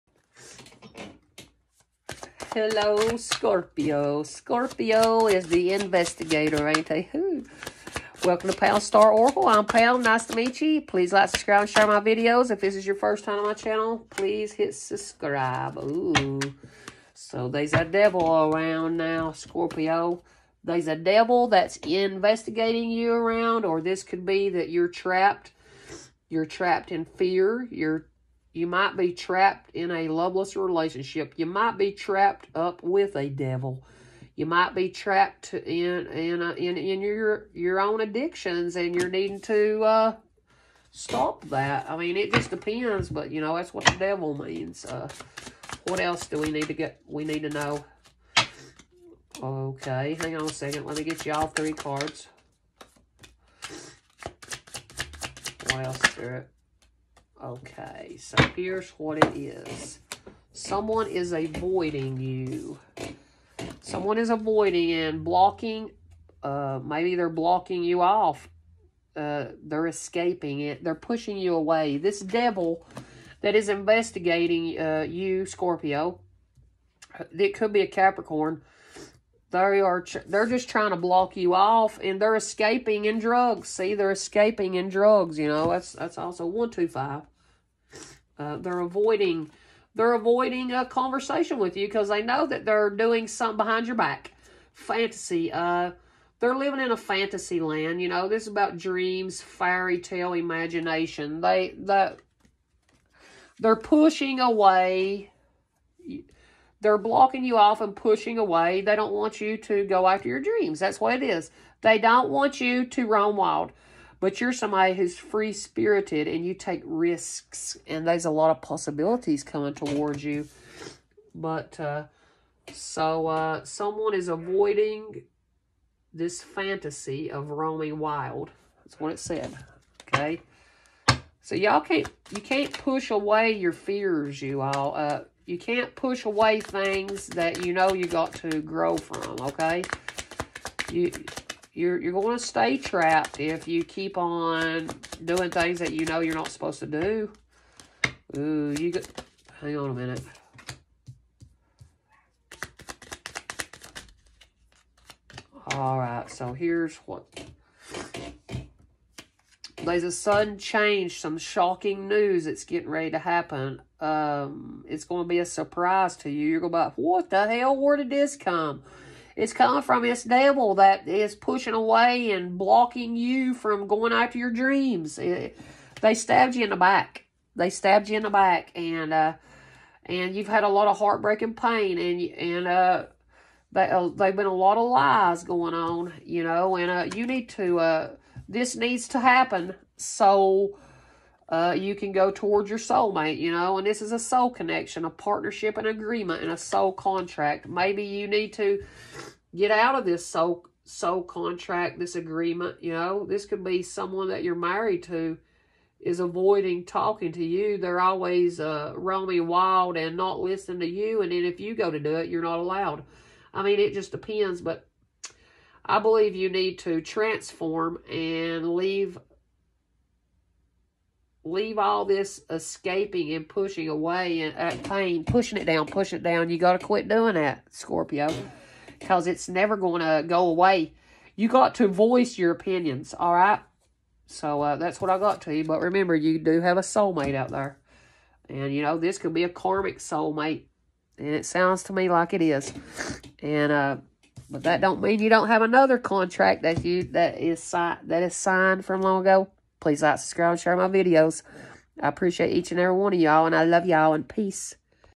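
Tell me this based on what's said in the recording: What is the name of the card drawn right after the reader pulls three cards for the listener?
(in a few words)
Wild Spirit.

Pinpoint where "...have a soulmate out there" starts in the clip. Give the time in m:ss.
3:56.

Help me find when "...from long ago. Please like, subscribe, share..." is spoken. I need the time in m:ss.
4:08.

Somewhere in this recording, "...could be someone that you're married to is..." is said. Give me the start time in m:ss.
3:23.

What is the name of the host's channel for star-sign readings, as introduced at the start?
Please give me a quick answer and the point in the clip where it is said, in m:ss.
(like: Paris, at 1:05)
Pam's Star Oracle, at 0:08.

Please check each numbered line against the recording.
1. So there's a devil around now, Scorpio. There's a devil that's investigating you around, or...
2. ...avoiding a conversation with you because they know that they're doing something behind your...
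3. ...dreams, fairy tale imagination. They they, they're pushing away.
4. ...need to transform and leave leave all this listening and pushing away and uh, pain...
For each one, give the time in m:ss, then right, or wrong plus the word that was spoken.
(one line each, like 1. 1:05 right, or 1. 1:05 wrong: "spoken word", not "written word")
1. 0:17 right
2. 1:30 right
3. 1:38 right
4. 3:36 wrong: "escaping", not "listening".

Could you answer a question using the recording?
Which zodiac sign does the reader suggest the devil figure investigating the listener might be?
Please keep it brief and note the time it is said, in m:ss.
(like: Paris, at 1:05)
Capricorn, at 1:17.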